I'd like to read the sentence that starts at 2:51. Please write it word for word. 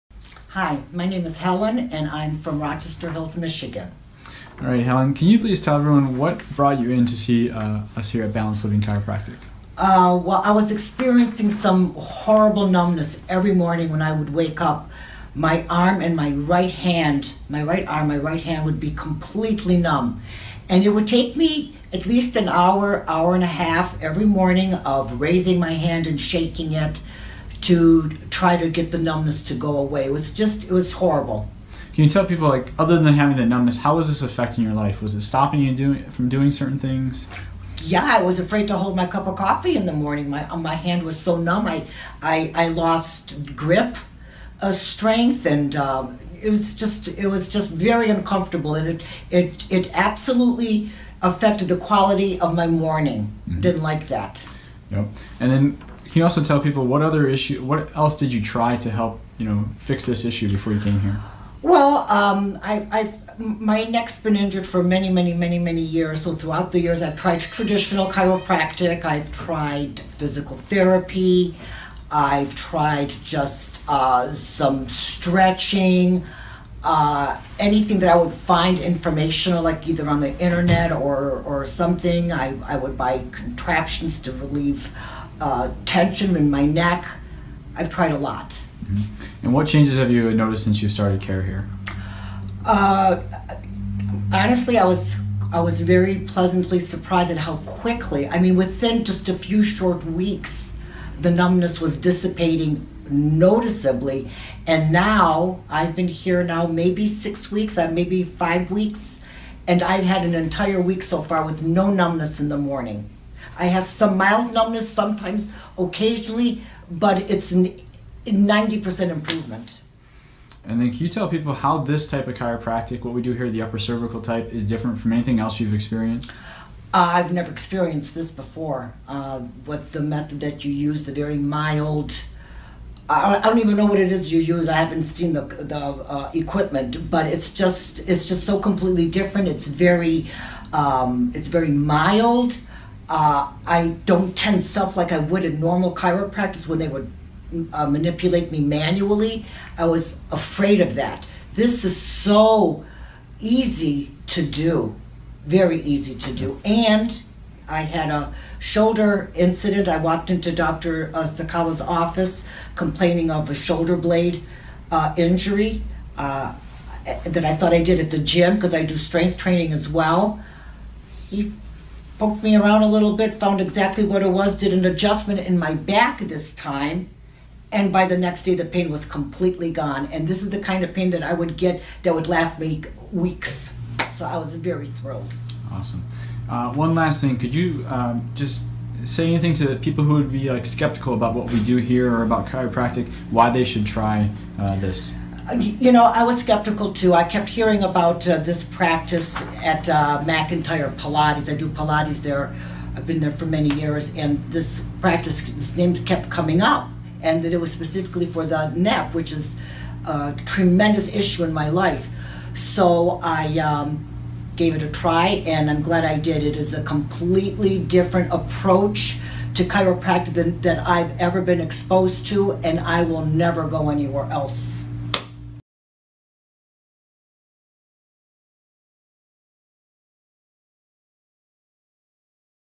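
He poked me around a little bit, found exactly what it was, did an adjustment in my back this time.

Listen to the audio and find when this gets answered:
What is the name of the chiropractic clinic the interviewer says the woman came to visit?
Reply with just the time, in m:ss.
0:08.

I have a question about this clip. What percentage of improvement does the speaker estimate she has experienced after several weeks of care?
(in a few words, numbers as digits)
90%.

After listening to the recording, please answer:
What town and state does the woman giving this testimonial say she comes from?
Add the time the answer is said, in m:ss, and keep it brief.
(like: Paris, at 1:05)
Rochester Hills, Michigan, at 0:02.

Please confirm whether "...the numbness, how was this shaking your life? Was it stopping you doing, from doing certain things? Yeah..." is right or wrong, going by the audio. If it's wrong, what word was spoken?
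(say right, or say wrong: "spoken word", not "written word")
wrong: "affecting", not "shaking".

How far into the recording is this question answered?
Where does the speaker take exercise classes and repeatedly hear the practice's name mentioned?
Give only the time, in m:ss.
3:20.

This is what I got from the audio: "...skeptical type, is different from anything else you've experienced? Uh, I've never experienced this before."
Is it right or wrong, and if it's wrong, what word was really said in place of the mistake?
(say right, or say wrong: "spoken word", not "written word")
wrong: "cervical", not "skeptical".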